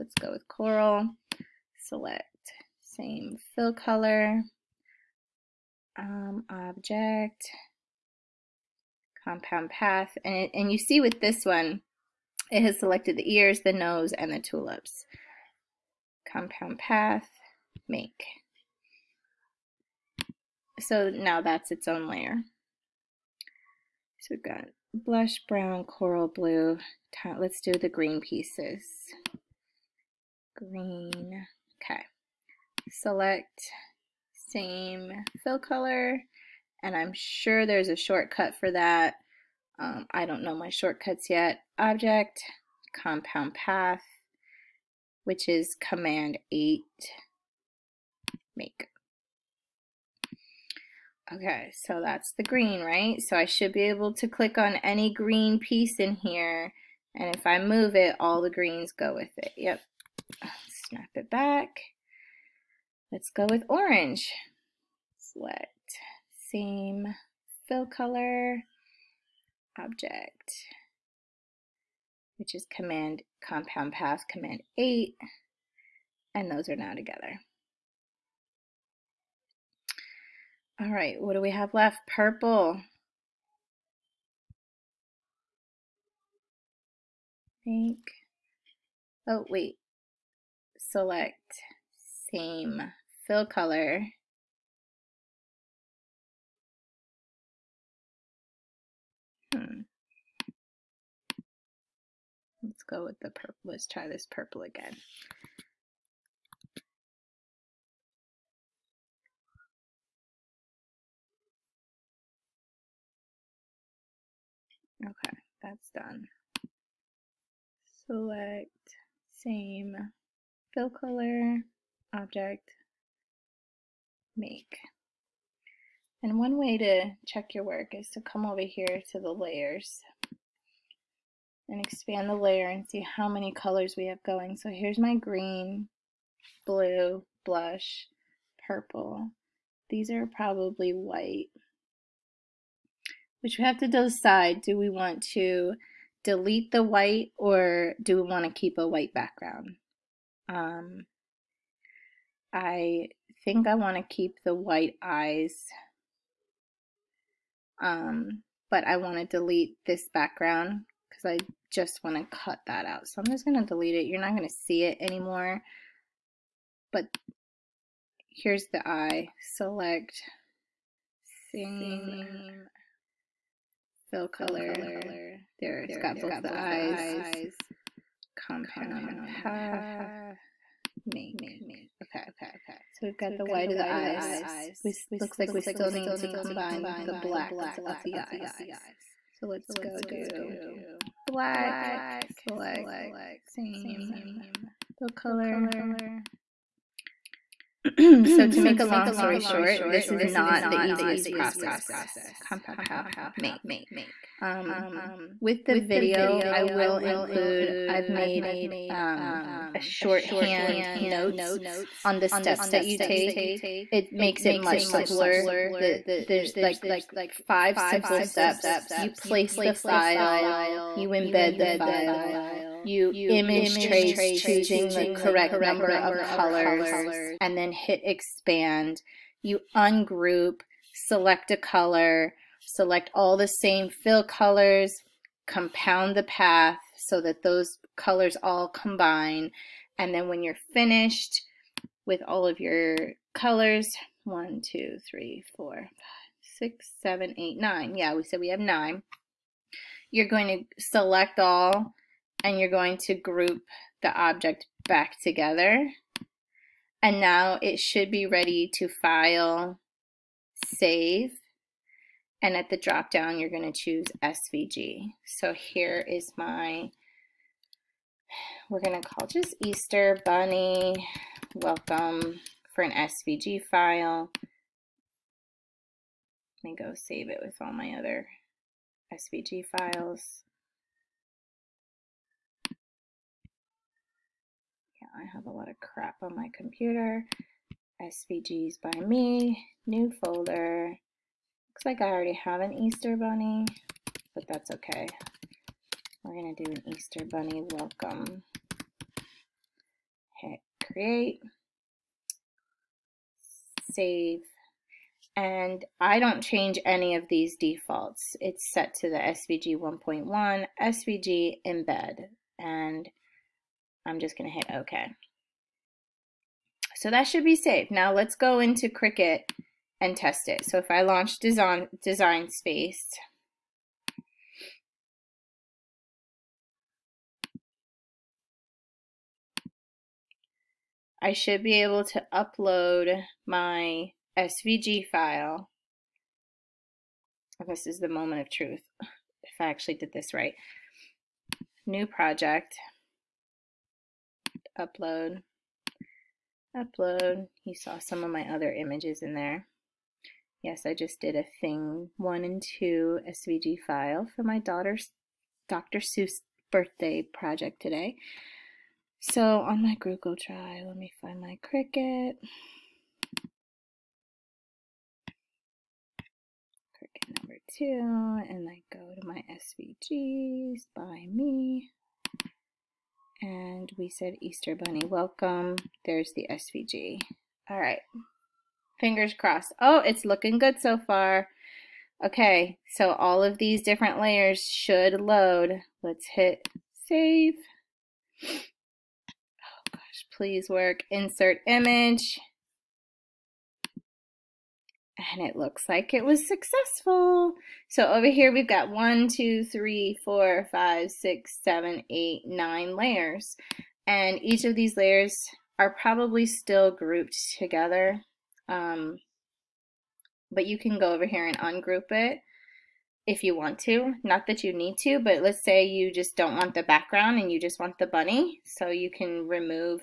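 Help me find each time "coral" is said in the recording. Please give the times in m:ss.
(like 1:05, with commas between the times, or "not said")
0:00, 0:25.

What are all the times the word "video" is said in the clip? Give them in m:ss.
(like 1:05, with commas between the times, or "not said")
3:25.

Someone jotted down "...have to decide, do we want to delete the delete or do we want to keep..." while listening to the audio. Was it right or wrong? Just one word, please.
wrong.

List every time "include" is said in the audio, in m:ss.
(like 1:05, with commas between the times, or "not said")
3:26.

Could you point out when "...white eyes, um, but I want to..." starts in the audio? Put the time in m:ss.
2:34.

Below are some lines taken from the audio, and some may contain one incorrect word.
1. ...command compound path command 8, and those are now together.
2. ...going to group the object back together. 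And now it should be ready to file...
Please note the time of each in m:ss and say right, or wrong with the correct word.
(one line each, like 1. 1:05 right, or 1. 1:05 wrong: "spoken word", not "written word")
1. 1:12 right
2. 4:12 right.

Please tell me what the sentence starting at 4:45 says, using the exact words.
Yeah, I have a lot of crap on my computer.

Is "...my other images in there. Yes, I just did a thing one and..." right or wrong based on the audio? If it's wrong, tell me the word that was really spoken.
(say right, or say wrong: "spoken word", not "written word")
right.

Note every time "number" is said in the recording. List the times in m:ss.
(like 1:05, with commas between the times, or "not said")
3:45, 6:07.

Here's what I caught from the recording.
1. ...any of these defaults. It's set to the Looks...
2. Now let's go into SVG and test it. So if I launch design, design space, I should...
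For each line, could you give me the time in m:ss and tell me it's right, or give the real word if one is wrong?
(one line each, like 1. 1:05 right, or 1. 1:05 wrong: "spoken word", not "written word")
1. 5:06 wrong: "SVG", not "Looks"
2. 5:17 wrong: "Cricut", not "SVG".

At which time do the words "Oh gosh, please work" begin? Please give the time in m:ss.
6:28.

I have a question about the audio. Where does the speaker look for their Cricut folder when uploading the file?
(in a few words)
Google Drive.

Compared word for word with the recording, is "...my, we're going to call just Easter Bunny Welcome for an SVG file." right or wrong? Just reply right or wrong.
right.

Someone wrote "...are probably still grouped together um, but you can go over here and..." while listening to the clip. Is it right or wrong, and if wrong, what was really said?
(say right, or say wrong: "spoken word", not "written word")
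right.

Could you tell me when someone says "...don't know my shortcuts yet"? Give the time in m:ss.
0:40.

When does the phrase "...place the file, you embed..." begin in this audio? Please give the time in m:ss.
3:39.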